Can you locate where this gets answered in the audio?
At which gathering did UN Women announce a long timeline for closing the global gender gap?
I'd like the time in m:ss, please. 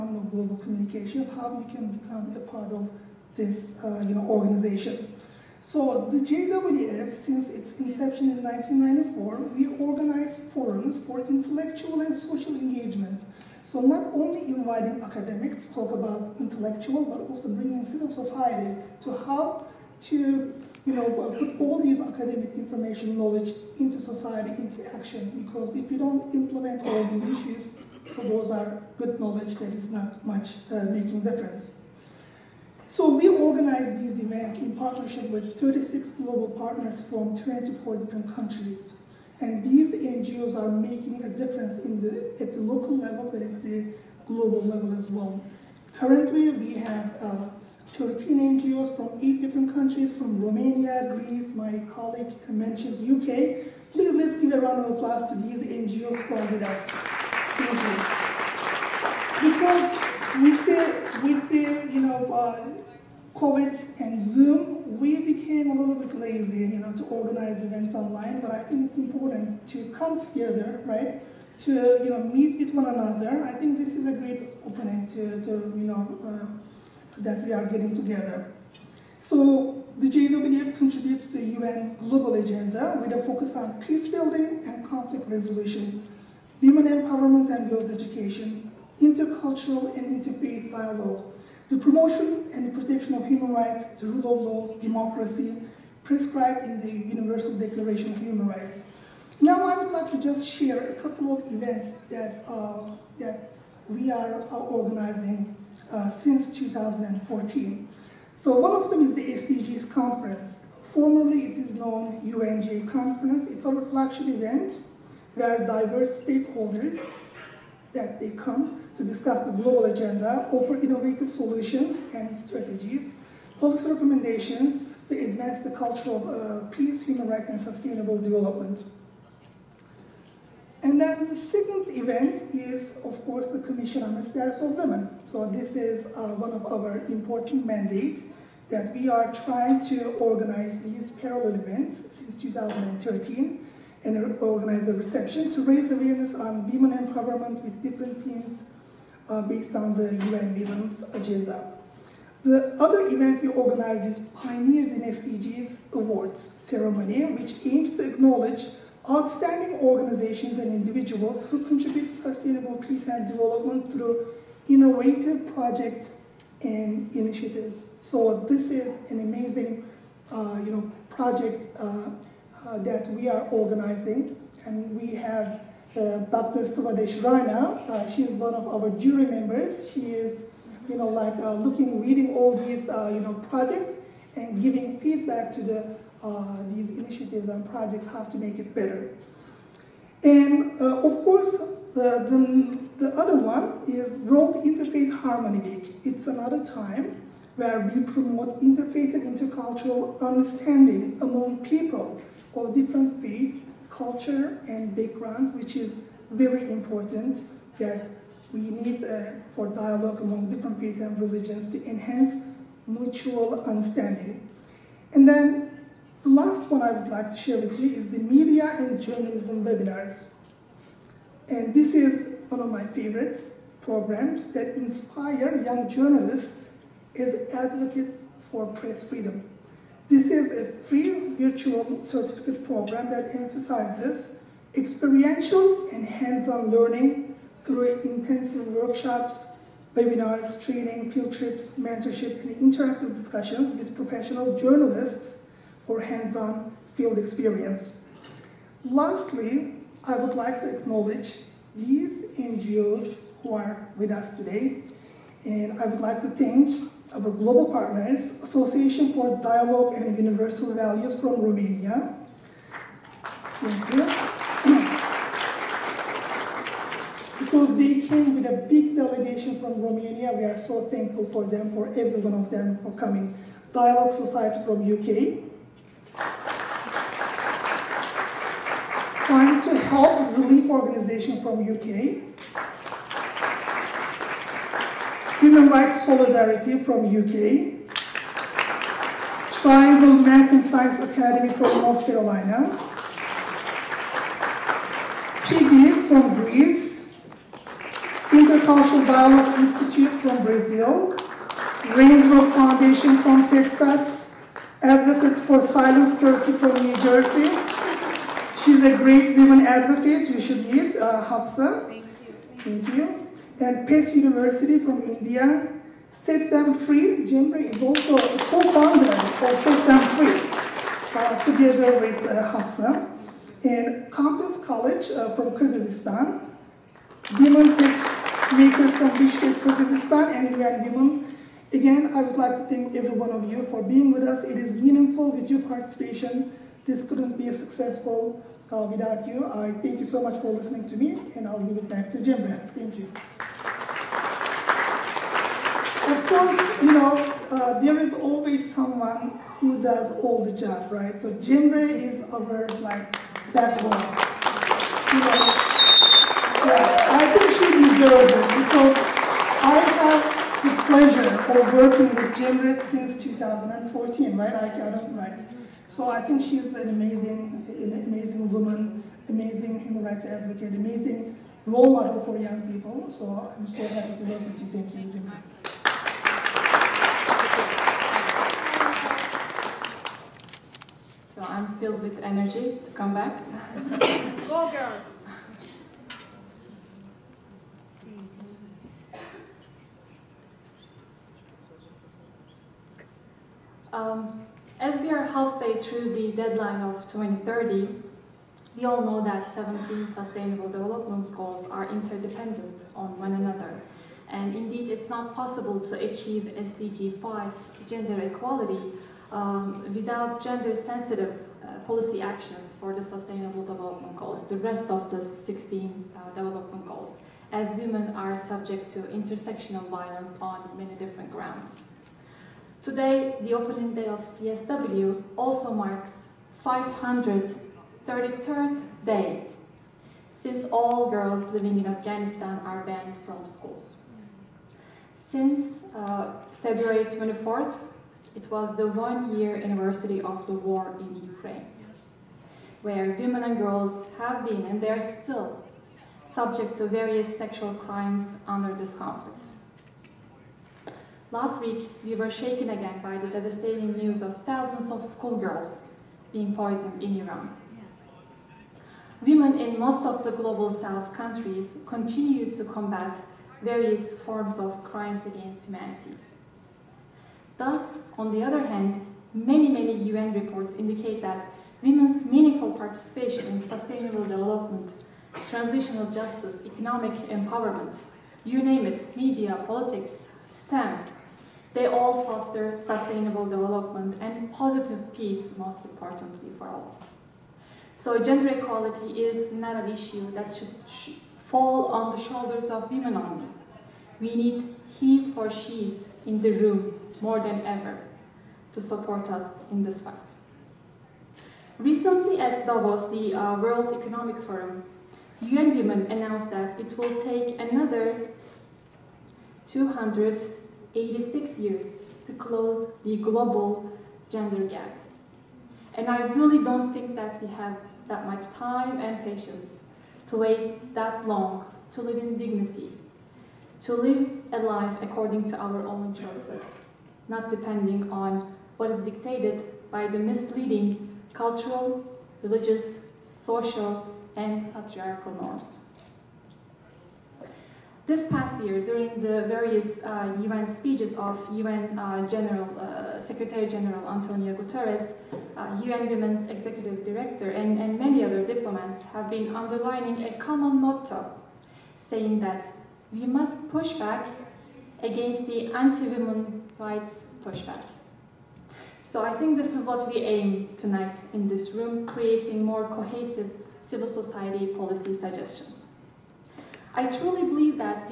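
8:22.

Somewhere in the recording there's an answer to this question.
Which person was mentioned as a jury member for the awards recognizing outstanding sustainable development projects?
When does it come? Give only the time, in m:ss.
2:56.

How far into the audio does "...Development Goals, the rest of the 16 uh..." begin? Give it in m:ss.
6:53.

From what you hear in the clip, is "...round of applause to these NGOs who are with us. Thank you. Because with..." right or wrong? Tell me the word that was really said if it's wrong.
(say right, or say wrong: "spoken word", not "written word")
right.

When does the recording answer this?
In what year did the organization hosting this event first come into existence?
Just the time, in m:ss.
0:08.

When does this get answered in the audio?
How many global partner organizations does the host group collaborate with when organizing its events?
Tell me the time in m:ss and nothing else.
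0:35.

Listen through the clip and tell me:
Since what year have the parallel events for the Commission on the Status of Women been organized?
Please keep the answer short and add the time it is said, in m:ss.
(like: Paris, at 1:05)
2013, at 2:22.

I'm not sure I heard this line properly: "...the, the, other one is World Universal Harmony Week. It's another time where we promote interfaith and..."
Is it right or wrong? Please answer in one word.
wrong.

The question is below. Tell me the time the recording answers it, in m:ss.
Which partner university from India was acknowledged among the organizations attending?
5:13.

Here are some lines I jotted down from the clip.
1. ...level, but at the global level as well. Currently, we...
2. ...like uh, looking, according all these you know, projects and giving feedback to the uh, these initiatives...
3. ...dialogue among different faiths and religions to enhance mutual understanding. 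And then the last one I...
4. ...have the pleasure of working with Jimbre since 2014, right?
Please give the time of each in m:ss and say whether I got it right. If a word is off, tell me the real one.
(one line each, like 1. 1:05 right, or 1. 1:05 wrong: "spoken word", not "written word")
1. 0:42 right
2. 3:01 wrong: "reading", not "according"
3. 3:29 right
4. 5:59 right.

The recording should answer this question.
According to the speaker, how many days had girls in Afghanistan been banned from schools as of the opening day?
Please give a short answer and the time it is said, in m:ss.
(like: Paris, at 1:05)
533, at 7:06.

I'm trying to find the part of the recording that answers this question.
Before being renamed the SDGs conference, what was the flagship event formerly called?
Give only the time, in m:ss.
1:52.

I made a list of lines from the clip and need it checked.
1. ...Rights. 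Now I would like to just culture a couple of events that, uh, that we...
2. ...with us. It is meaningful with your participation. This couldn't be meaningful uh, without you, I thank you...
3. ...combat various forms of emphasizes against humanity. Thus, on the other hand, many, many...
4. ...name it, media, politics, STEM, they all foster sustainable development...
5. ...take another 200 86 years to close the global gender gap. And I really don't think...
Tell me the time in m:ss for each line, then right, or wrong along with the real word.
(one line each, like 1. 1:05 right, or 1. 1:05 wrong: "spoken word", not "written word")
1. 1:38 wrong: "share", not "culture"
2. 5:34 wrong: "successful", not "meaningful"
3. 7:42 wrong: "crimes", not "emphasizes"
4. 7:58 right
5. 8:27 right.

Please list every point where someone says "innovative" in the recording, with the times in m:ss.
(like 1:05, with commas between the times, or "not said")
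2:00, 2:44.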